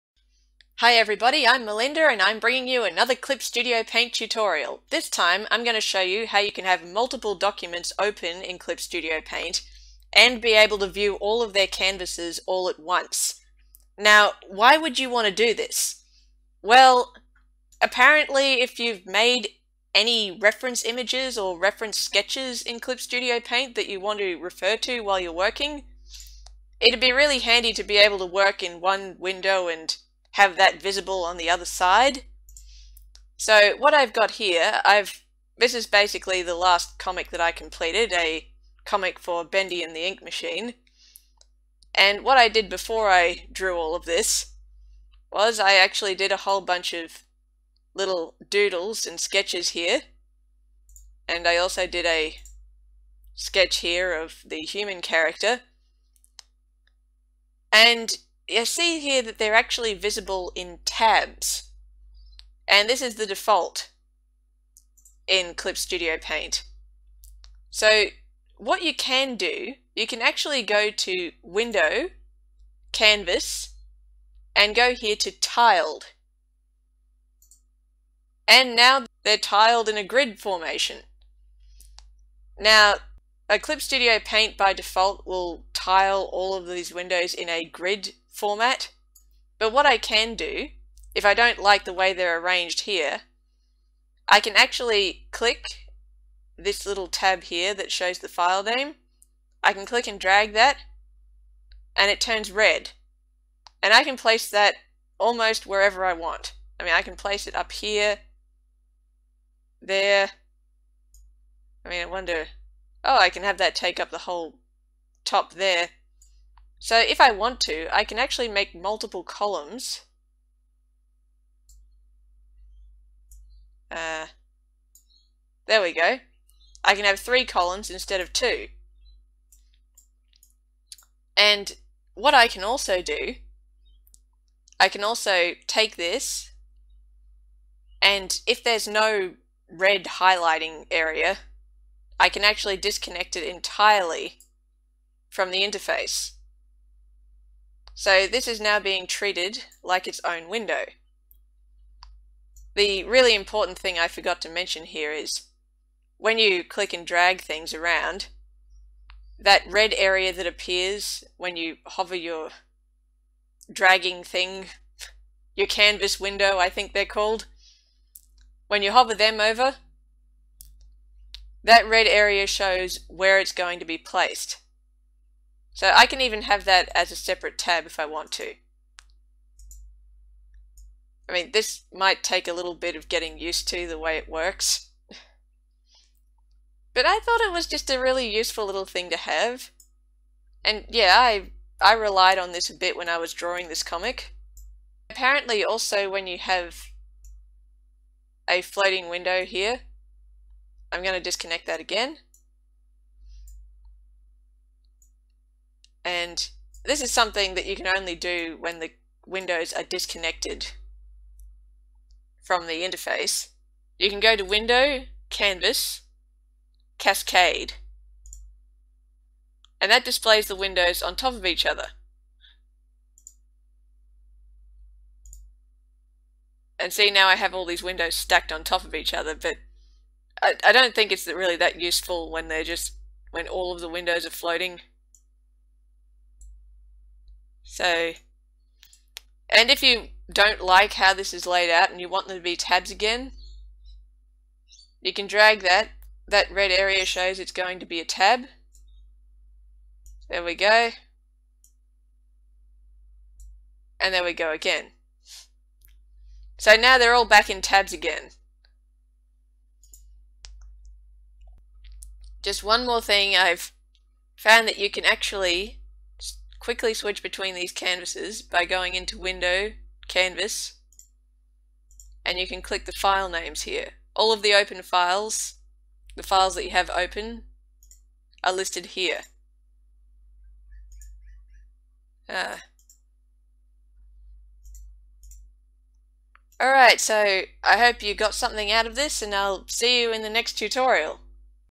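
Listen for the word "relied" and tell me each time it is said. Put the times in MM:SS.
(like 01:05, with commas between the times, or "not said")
03:11.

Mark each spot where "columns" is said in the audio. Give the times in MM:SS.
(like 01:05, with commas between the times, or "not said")
01:59, 02:07.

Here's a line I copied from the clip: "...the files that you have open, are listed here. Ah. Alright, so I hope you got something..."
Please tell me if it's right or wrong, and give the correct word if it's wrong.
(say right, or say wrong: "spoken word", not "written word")
right.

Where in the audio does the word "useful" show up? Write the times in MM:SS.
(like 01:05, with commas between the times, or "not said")
03:08, 03:51.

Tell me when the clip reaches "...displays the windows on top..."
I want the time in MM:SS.
03:40.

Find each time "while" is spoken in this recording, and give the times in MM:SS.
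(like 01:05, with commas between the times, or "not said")
00:25.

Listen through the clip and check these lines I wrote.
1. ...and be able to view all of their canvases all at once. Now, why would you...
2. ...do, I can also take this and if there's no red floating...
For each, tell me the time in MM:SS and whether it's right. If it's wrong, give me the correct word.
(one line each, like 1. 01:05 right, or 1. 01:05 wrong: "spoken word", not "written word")
1. 00:10 right
2. 02:13 wrong: "highlighting", not "floating".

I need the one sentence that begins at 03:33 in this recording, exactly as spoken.
You can go to Window, Canvas, Cascade.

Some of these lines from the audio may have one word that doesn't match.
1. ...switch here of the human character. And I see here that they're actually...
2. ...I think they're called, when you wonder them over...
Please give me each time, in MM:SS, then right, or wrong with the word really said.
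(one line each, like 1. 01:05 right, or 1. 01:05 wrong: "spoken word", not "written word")
1. 00:53 wrong: "sketch", not "switch"
2. 02:46 wrong: "hover", not "wonder".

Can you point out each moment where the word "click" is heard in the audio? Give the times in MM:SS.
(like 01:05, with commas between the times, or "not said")
01:35, 01:39, 02:36, 04:32.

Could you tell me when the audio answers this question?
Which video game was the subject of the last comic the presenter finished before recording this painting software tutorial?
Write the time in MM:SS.
00:39.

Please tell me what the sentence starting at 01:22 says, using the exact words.
Now, Clip Studio Paint by default will tile all of these windows in a grid format.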